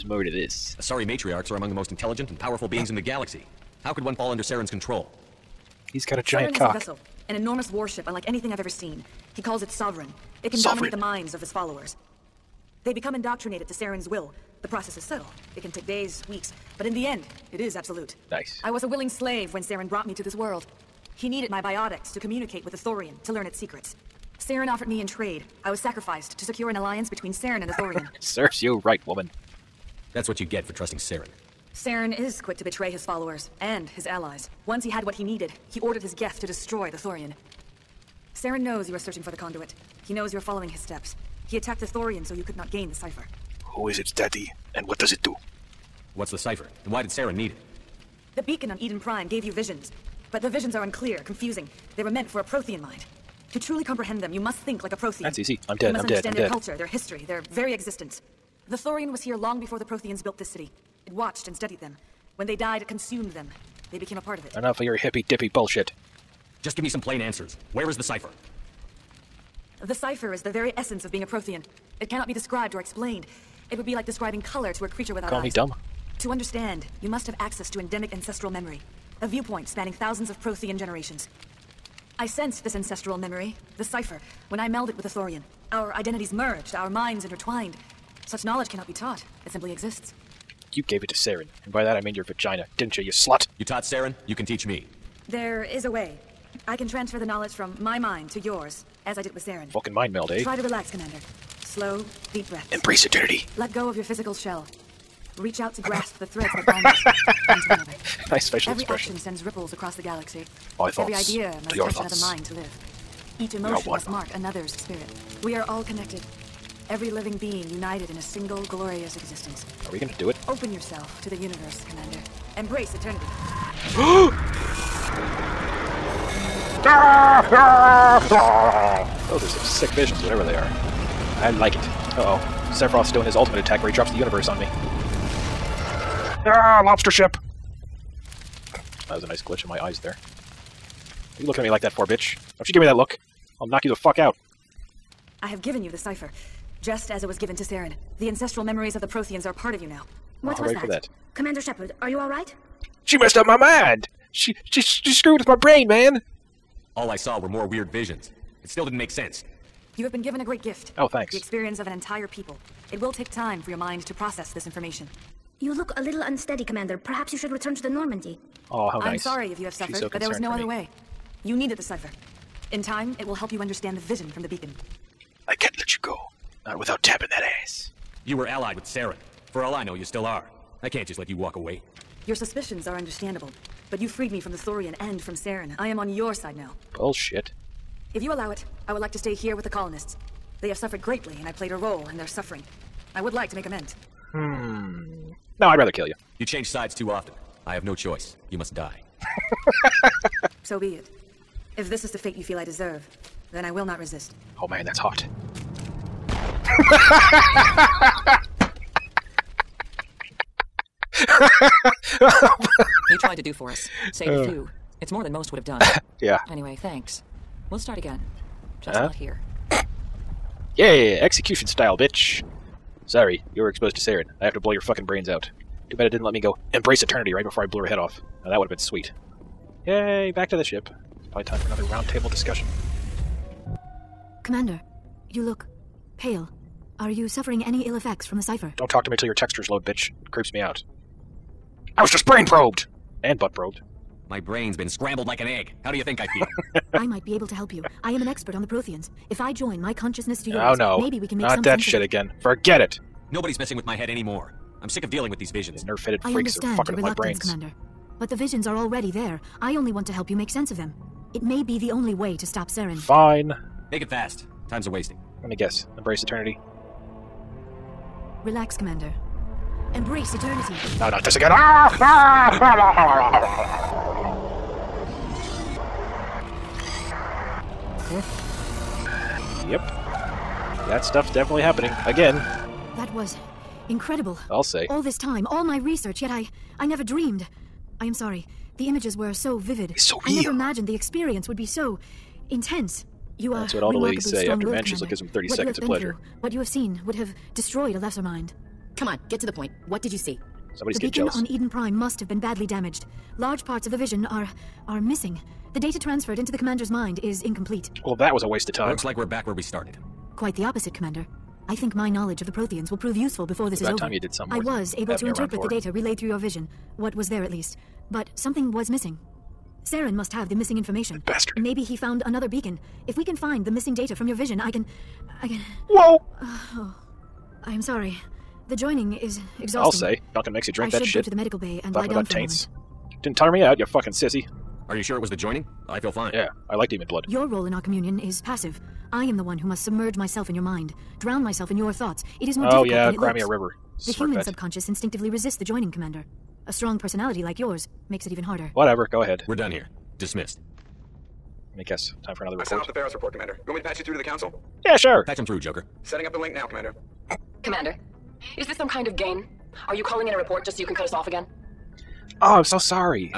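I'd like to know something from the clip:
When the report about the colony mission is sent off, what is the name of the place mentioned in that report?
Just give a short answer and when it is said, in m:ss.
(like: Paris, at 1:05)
Feros, at 5:52.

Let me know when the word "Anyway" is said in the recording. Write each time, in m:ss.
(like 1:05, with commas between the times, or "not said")
3:36.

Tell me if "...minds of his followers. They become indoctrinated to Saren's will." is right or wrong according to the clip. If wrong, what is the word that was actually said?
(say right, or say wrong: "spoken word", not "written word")
right.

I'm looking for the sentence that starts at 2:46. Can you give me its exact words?
Perhaps you should return to the Normandy.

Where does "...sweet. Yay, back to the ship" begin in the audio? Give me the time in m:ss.
3:48.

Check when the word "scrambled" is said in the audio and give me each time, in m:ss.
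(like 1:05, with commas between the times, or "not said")
4:04.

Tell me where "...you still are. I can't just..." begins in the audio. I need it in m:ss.
2:59.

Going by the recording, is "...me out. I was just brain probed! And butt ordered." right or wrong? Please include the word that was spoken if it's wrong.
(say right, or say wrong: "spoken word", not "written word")
wrong: "probed", not "ordered".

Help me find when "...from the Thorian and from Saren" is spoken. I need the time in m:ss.
3:04.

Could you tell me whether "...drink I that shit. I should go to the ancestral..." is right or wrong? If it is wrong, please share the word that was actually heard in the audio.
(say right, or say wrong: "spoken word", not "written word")
wrong: "medical", not "ancestral".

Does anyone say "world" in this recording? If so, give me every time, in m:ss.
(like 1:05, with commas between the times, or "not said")
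0:20.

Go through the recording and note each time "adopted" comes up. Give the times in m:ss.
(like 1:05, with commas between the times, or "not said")
not said.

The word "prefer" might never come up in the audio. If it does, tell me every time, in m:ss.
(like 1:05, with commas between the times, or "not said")
not said.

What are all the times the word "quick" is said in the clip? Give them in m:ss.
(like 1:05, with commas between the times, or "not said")
0:32.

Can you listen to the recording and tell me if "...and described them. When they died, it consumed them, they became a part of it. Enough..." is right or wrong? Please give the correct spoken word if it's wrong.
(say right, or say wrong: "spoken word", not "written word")
wrong: "studied", not "described".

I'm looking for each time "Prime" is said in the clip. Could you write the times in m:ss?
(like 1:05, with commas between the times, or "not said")
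0:48, 5:01.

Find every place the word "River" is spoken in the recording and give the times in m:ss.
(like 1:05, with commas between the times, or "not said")
5:43.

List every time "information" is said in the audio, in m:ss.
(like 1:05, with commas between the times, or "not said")
2:44, 5:20.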